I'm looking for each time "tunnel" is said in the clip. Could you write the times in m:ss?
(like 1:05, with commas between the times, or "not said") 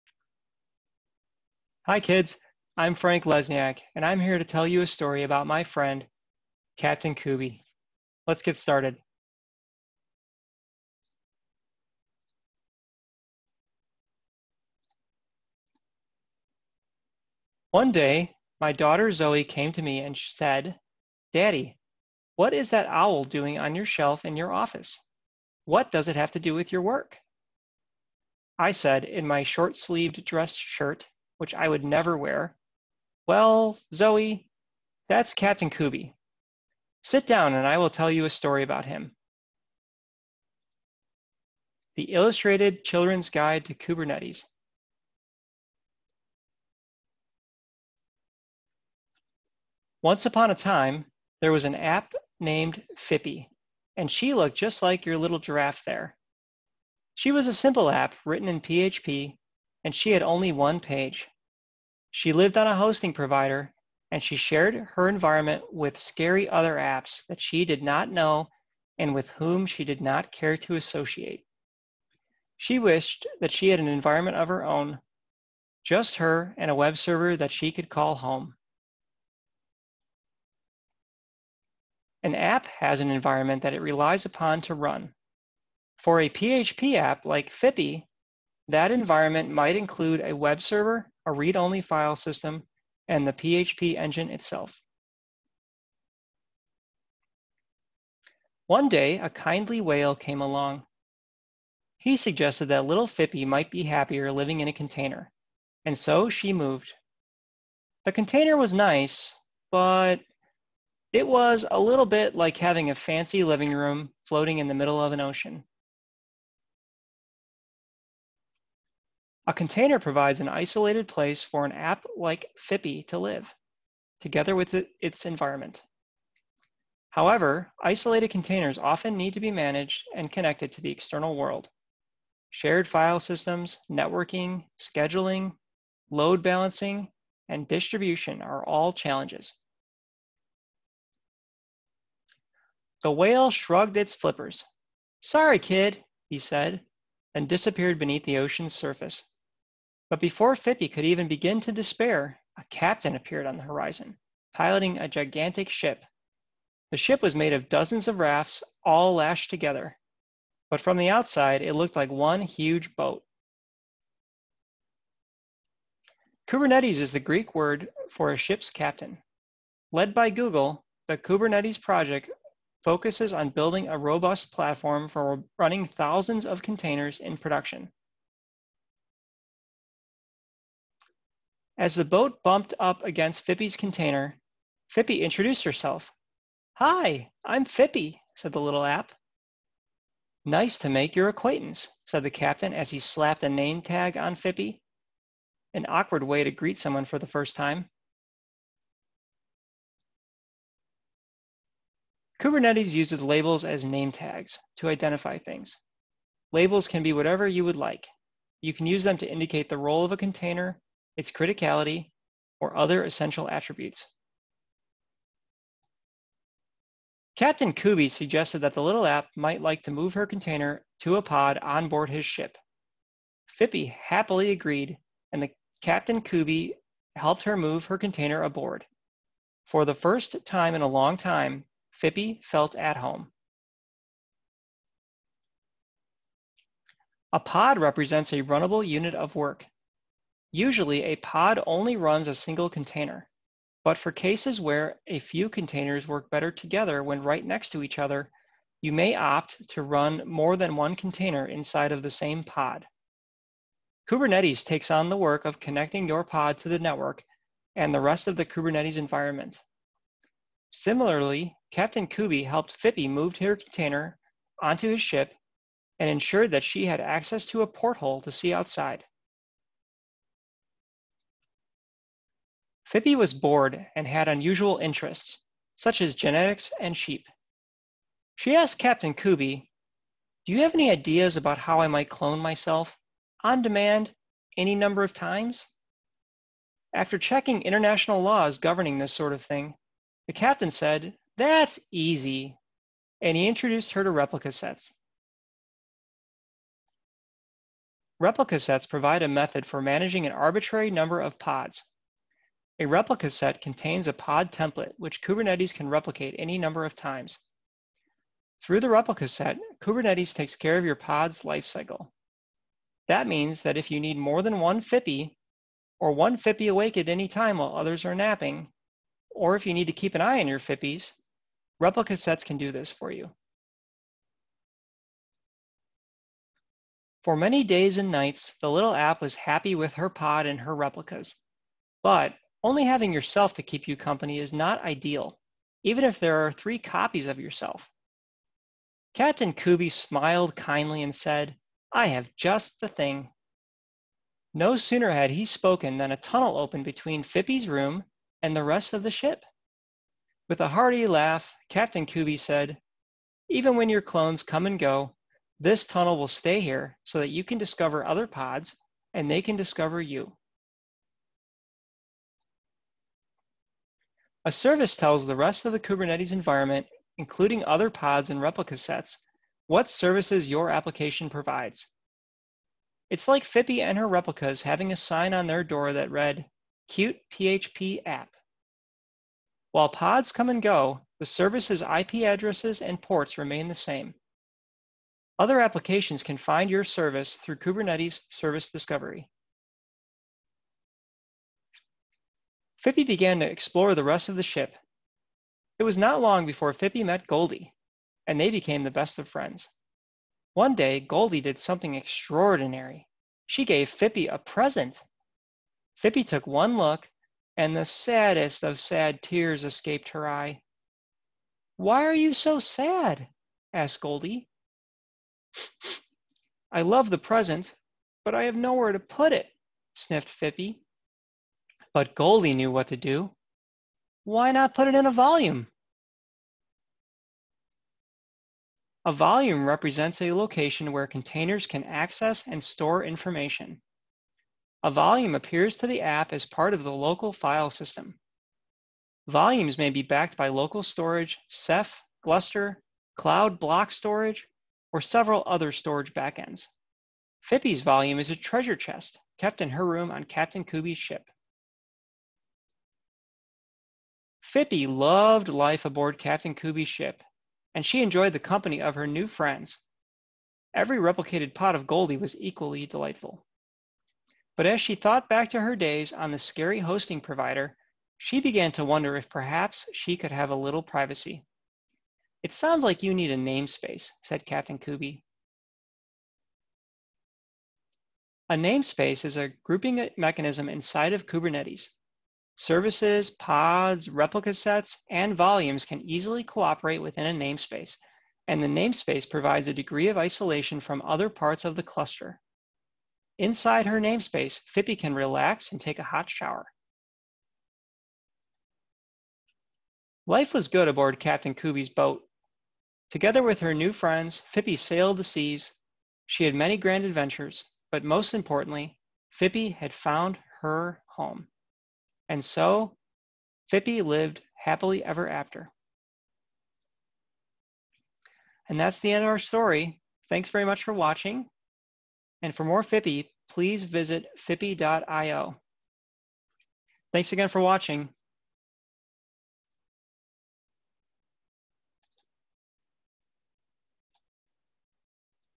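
5:46, 5:55.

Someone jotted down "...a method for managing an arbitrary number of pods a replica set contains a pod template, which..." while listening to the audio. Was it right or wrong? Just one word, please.
right.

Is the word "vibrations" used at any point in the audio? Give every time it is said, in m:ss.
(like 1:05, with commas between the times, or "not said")
not said.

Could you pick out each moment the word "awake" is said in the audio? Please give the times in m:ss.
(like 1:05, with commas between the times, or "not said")
5:16.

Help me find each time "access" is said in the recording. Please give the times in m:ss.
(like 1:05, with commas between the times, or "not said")
4:26, 7:11.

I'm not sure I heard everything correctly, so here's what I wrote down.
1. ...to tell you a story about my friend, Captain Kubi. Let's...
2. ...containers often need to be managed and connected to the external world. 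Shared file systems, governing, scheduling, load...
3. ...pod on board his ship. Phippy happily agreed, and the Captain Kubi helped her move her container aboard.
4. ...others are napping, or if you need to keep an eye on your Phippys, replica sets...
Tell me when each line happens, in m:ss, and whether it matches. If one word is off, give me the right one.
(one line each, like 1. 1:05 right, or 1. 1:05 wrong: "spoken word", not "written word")
1. 0:04 right
2. 2:08 wrong: "networking", not "governing"
3. 3:41 right
4. 5:17 right.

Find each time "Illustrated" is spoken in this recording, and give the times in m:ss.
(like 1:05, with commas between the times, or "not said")
0:42.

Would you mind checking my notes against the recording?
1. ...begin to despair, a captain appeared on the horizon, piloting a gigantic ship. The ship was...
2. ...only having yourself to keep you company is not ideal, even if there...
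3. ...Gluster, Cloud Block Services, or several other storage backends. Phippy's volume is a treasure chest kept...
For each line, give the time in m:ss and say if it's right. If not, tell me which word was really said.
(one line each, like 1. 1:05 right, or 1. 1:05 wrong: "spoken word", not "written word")
1. 2:31 right
2. 5:32 right
3. 7:22 wrong: "Storage", not "Services".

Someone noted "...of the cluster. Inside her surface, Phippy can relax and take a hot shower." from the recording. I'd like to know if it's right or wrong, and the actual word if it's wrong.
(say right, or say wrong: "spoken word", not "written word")
wrong: "namespace", not "surface".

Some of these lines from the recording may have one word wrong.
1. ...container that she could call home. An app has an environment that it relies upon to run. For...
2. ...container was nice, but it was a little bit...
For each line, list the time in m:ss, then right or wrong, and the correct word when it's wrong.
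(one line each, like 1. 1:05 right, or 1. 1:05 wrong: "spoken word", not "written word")
1. 1:16 wrong: "server", not "container"
2. 1:48 right.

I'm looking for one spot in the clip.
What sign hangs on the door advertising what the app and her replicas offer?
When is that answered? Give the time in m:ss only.
6:16.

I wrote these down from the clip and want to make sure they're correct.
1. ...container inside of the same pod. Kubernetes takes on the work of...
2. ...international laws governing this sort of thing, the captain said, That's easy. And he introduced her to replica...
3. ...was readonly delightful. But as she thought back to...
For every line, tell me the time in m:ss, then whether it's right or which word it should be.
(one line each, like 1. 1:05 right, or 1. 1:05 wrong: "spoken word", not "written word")
1. 4:10 right
2. 4:47 right
3. 7:42 wrong: "equally", not "readonly".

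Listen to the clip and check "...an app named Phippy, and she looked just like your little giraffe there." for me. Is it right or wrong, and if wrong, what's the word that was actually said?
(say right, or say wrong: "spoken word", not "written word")
right.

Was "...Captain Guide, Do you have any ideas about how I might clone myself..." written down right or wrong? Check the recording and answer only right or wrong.
wrong.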